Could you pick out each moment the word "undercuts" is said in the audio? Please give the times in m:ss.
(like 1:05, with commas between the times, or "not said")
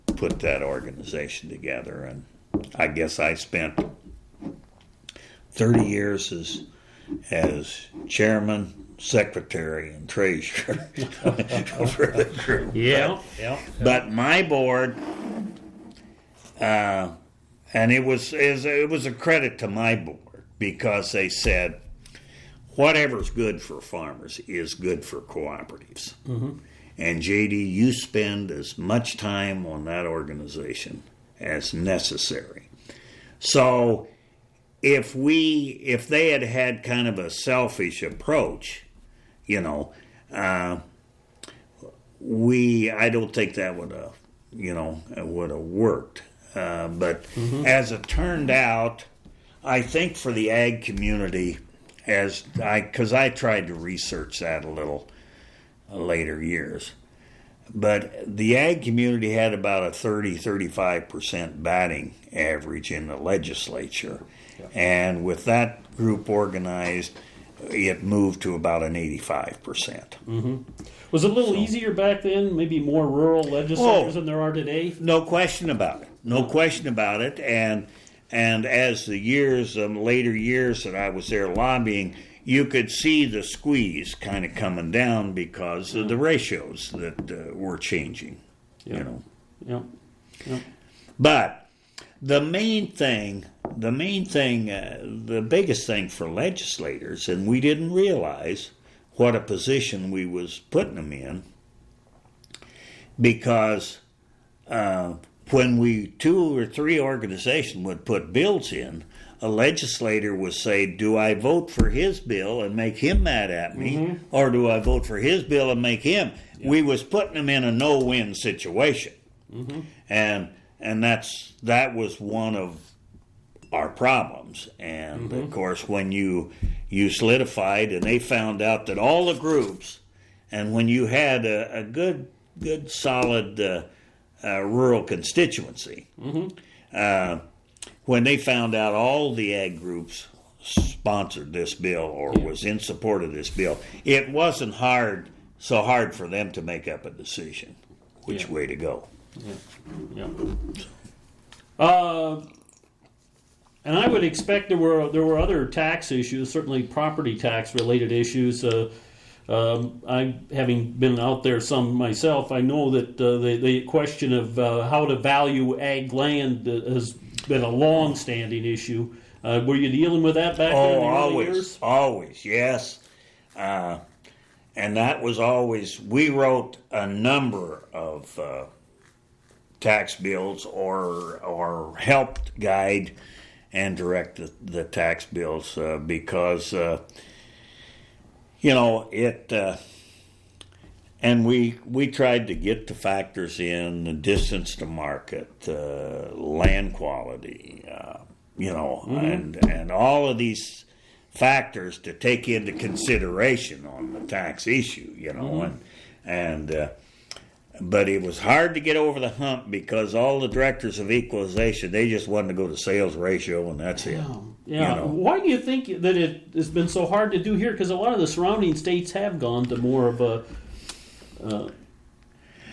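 not said.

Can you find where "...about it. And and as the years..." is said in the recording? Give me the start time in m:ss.
1:16.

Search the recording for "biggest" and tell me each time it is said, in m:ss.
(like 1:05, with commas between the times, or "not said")
1:35.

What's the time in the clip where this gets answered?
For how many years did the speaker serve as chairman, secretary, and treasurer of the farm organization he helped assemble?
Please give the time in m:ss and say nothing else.
0:05.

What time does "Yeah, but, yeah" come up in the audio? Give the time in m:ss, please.
0:12.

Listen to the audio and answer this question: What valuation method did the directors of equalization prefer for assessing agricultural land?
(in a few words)
Sales ratio.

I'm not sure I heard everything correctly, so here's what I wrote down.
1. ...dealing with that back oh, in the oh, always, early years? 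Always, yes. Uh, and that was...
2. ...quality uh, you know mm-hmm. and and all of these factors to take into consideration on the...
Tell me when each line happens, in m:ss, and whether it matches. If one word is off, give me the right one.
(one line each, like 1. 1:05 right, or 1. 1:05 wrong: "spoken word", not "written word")
1. 2:49 right
2. 3:16 right.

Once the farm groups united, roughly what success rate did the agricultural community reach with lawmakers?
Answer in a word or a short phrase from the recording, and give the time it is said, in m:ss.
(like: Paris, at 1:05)
85%, at 1:08.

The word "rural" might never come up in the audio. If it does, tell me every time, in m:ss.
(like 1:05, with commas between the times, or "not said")
1:13, 2:14.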